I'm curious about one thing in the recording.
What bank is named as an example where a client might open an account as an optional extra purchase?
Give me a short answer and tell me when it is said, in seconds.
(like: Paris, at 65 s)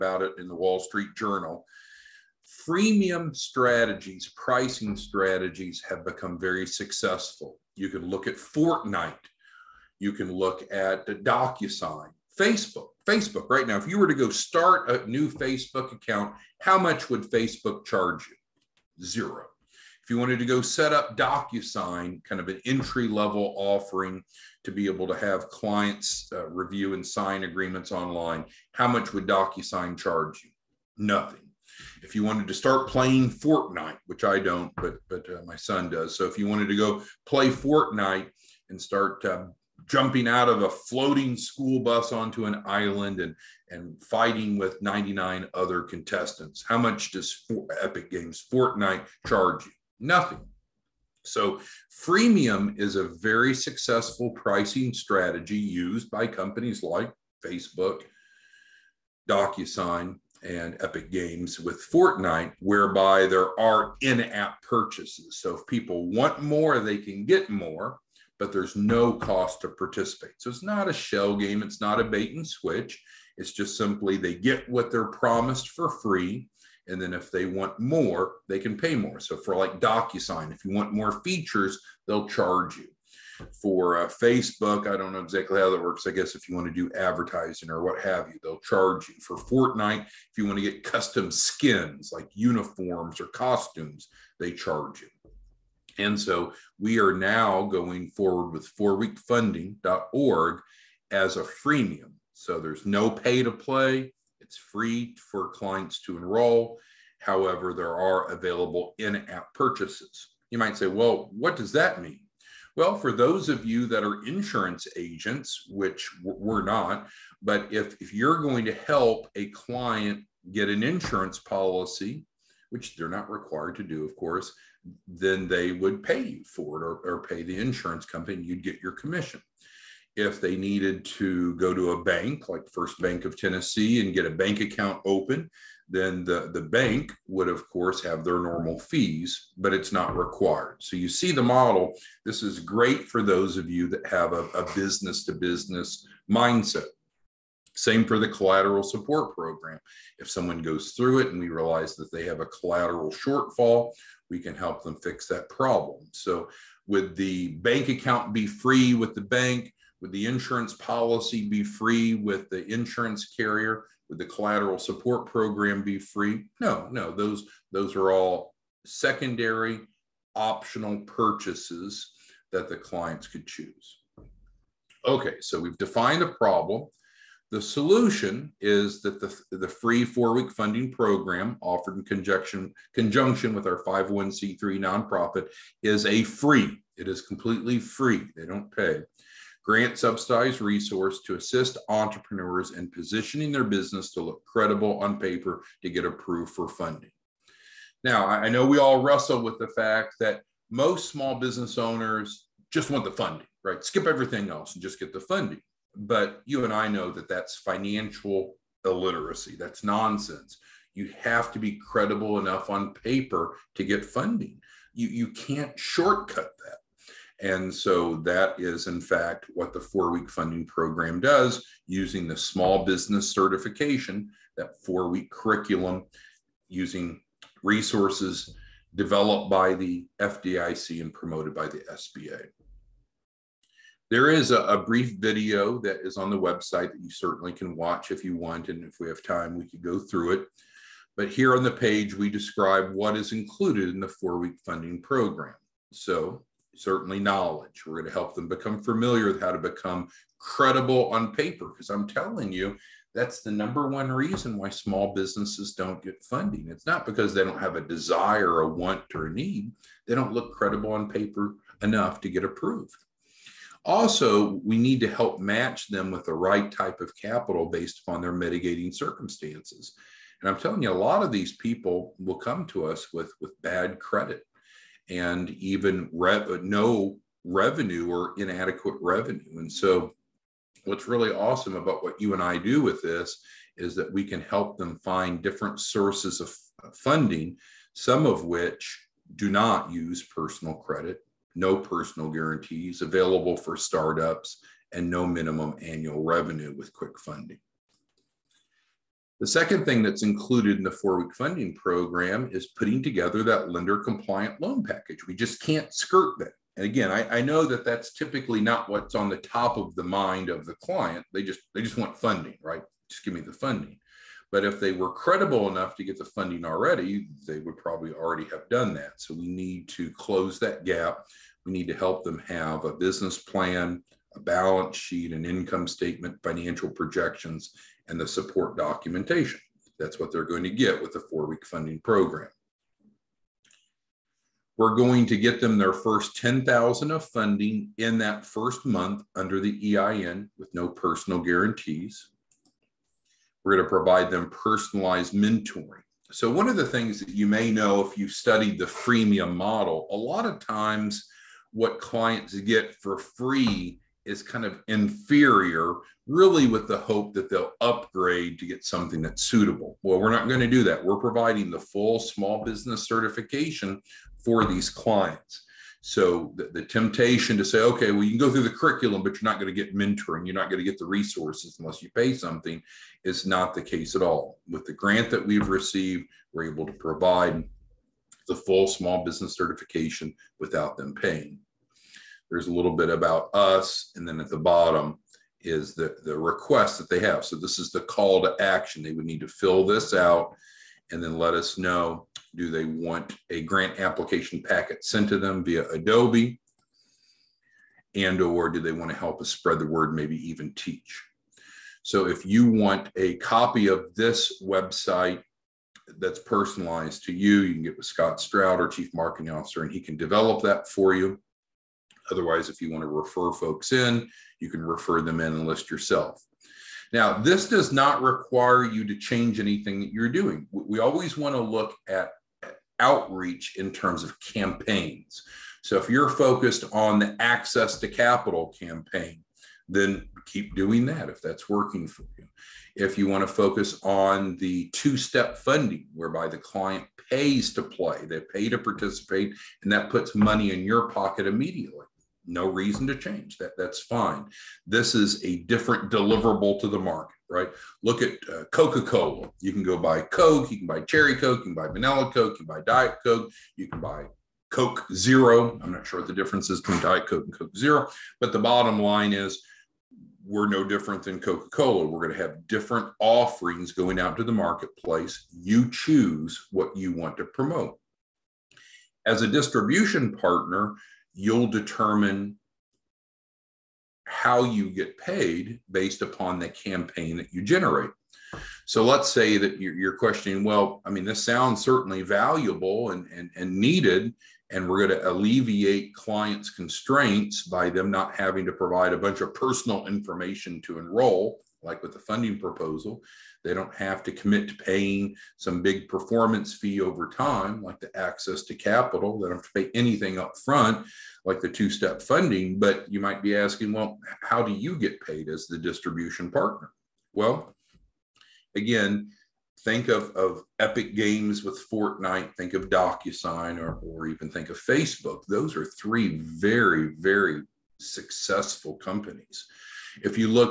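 First Bank of Tennessee, at 132 s.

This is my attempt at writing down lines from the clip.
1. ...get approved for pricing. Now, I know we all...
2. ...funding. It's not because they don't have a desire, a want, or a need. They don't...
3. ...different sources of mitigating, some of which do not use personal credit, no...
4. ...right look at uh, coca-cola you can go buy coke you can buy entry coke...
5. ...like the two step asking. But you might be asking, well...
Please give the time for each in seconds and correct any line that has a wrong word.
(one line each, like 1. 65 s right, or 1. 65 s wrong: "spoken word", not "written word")
1. 195 s wrong: "funding", not "pricing"
2. 256 s right
3. 285 s wrong: "funding", not "mitigating"
4. 447 s wrong: "cherry", not "entry"
5. 501 s wrong: "funding", not "asking".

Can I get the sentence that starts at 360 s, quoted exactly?
Well, we're not going to do that.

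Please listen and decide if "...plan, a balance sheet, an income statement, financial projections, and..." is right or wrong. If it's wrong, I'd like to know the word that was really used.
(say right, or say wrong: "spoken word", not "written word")
right.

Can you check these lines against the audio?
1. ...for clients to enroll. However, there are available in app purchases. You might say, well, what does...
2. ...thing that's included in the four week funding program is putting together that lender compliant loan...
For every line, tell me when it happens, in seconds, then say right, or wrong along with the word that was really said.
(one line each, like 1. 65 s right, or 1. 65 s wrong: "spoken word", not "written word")
1. 105 s right
2. 299 s right.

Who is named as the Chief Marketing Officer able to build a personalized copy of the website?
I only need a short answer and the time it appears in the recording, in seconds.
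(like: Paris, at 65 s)
Scott Stroud, at 408 s.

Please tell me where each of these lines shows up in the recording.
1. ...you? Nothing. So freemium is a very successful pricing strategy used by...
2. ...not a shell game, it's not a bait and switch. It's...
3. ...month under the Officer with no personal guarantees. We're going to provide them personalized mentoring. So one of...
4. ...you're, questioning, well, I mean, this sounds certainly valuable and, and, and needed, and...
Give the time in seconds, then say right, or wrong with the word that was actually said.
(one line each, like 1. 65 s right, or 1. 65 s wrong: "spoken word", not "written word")
1. 49 s right
2. 70 s right
3. 338 s wrong: "EIN", not "Officer"
4. 479 s right.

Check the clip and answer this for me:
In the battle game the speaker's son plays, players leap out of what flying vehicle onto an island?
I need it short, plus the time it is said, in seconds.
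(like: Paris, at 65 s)
a floating school bus, at 40 s.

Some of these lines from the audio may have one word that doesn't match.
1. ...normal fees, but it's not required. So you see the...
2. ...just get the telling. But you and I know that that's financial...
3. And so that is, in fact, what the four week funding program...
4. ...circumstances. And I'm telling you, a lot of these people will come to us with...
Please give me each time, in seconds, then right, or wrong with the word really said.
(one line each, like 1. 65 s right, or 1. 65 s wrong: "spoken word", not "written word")
1. 138 s right
2. 204 s wrong: "funding", not "telling"
3. 217 s right
4. 268 s right.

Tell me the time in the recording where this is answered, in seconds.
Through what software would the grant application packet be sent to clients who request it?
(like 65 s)
395 s.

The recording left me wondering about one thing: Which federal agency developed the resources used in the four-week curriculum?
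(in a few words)
FDIC.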